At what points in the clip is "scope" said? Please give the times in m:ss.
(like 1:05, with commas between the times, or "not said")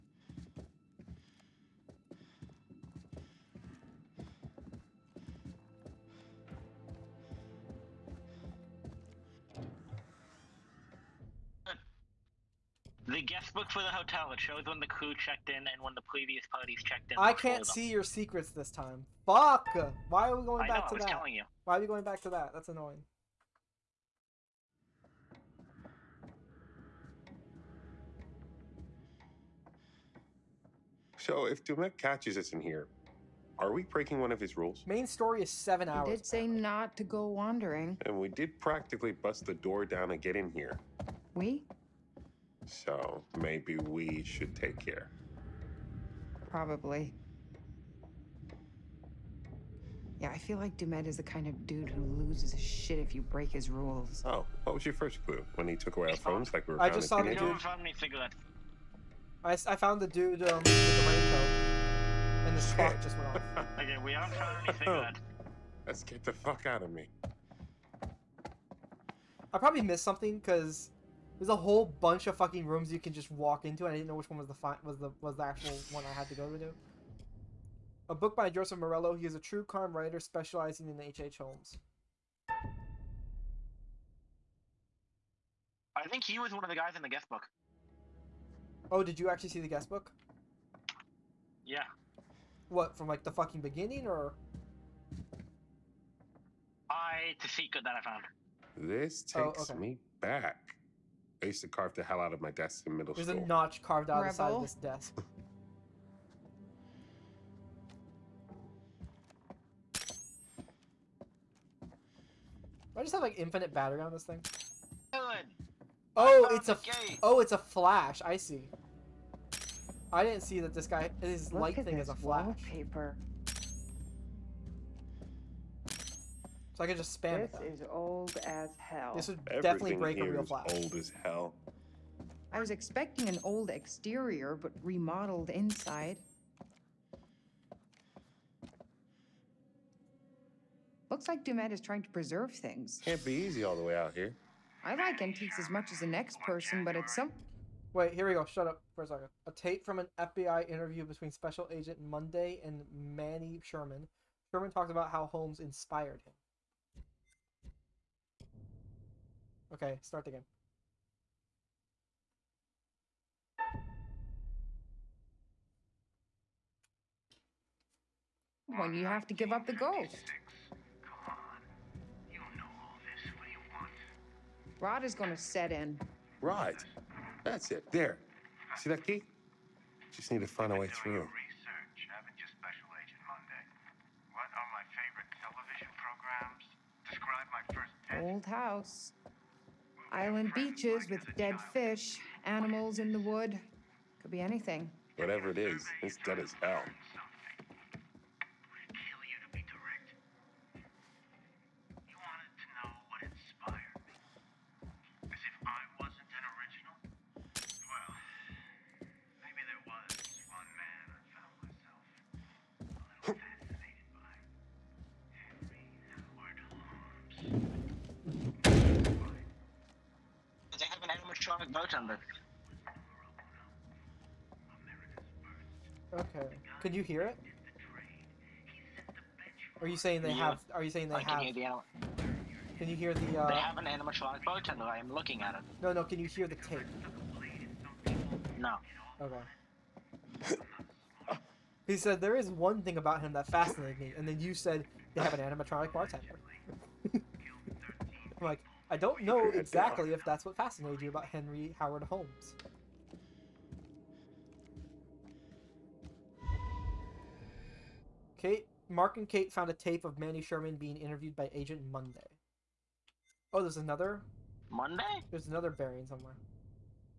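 not said.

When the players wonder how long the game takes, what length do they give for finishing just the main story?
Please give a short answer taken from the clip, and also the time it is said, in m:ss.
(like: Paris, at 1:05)
7 hours, at 0:35.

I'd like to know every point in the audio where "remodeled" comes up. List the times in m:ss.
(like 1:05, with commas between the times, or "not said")
2:14.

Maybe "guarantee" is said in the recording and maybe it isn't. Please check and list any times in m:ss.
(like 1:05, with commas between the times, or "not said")
not said.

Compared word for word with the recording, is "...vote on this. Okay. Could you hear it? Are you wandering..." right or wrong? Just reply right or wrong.
wrong.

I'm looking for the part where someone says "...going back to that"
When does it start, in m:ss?
0:21.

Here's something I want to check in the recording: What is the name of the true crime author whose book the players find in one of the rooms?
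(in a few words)
Joseph Morello.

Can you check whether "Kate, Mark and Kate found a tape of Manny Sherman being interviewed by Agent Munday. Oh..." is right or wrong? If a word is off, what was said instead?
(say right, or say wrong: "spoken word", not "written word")
right.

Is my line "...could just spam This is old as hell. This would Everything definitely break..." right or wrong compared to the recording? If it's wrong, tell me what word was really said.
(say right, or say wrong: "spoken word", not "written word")
right.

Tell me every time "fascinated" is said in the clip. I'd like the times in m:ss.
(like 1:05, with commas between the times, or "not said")
4:03, 4:10.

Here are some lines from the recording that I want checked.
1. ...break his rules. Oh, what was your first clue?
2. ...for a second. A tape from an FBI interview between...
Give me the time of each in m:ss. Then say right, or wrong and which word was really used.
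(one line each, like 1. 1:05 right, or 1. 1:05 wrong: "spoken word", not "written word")
1. 0:53 right
2. 2:28 right.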